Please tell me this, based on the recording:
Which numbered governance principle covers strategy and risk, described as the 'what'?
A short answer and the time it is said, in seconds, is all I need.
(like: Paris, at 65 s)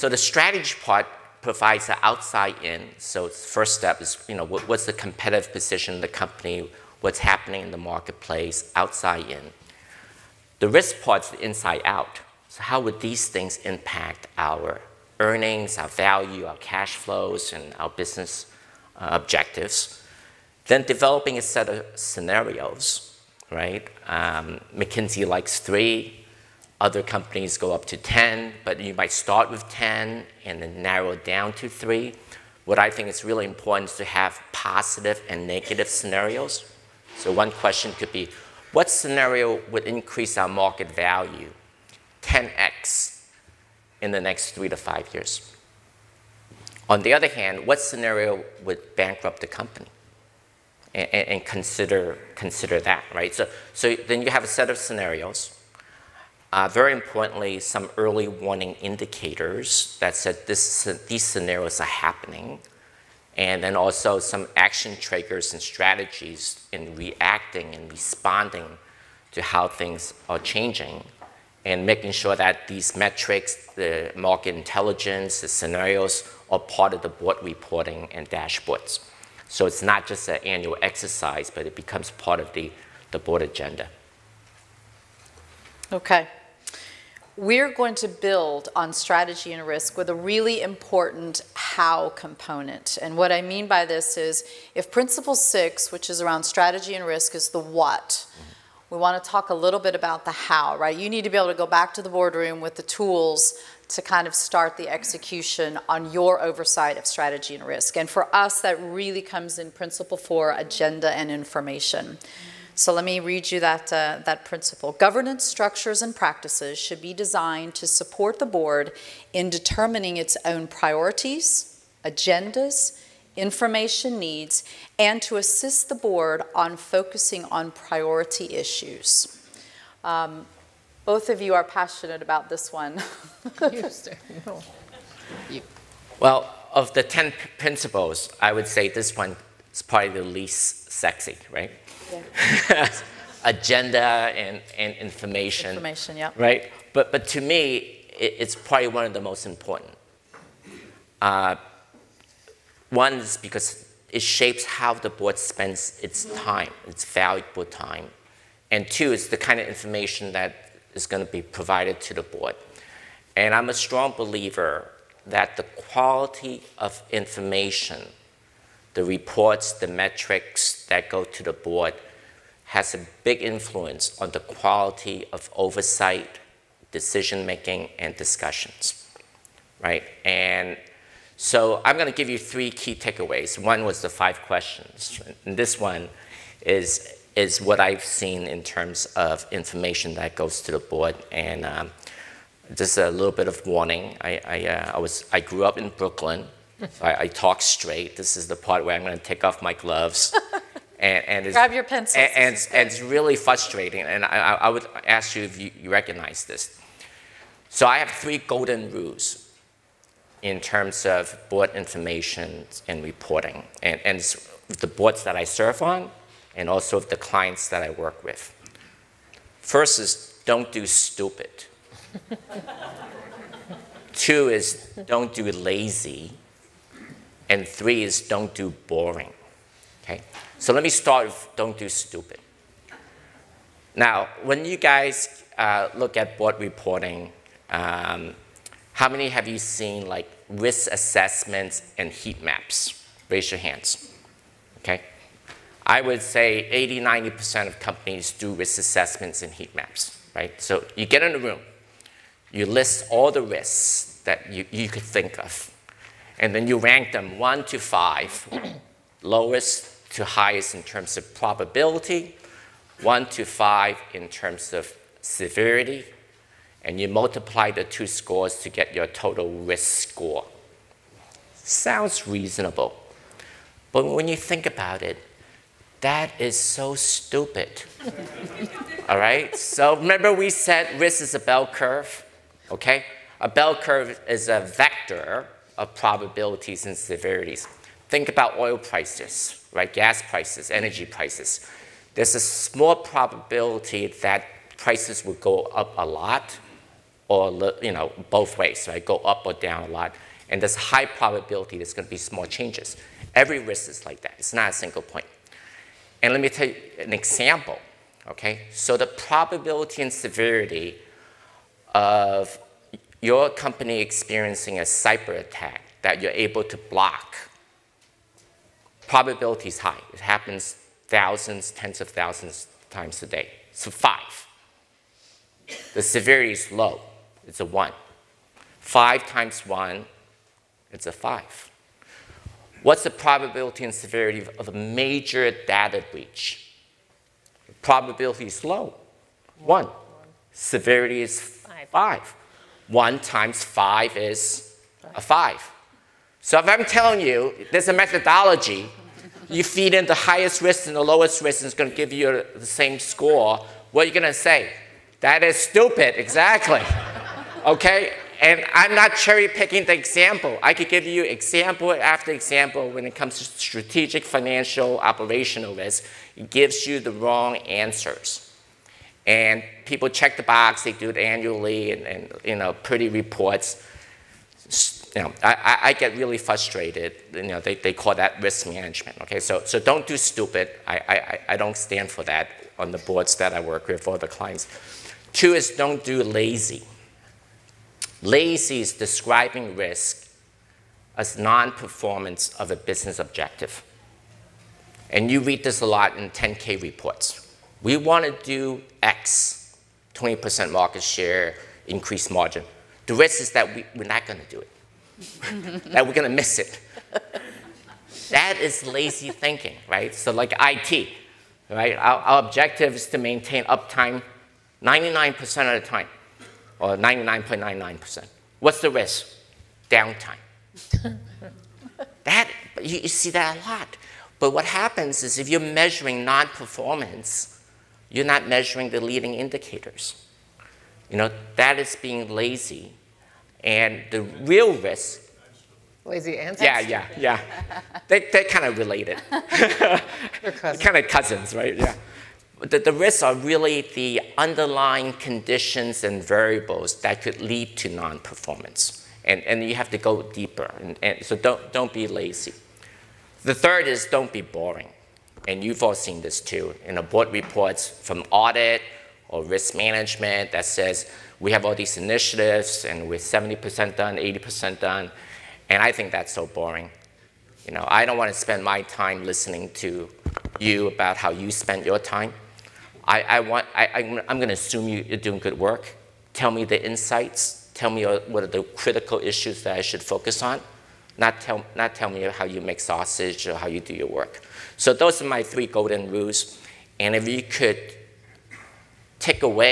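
Principle 6, at 94 s.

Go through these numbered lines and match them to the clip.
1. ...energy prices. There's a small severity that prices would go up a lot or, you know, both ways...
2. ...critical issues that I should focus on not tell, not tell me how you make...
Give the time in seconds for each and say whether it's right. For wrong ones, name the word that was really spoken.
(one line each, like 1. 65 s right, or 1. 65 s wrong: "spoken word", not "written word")
1. 290 s wrong: "probability", not "severity"
2. 478 s right.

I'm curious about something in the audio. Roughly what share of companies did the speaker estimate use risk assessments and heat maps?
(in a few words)
80-90%.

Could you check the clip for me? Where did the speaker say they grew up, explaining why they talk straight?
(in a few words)
Brooklyn.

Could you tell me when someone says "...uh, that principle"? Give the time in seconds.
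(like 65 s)
113 s.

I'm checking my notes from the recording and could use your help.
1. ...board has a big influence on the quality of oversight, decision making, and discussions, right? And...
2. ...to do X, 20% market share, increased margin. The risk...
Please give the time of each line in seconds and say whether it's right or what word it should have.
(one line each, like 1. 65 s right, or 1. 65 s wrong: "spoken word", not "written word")
1. 171 s right
2. 398 s right.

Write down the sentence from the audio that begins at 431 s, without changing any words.
You know, that is being lazy.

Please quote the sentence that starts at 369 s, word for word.
And people check the box, they do it annually, and, and you know, pretty reports.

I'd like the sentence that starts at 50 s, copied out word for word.
And, and, consider, consider that, right?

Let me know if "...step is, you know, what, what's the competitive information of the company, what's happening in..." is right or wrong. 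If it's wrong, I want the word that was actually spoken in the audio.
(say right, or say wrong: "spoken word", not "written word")
wrong: "position", not "information".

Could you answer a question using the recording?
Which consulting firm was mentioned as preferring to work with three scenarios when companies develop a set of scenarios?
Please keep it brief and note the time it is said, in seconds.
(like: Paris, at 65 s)
McKinsey, at 24 s.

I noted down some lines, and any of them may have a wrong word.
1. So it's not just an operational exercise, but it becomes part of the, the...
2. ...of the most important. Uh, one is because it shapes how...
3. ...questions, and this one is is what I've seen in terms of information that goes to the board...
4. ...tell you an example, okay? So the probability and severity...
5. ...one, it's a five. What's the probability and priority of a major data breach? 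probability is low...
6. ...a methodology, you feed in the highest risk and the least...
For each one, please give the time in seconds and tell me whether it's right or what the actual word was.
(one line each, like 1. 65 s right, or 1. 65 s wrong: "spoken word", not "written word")
1. 79 s wrong: "annual", not "operational"
2. 149 s right
3. 184 s right
4. 306 s right
5. 329 s wrong: "severity", not "priority"
6. 347 s wrong: "lowest", not "least".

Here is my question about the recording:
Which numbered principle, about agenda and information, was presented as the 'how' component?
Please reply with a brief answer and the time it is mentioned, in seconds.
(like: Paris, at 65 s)
Principle 4, at 109 s.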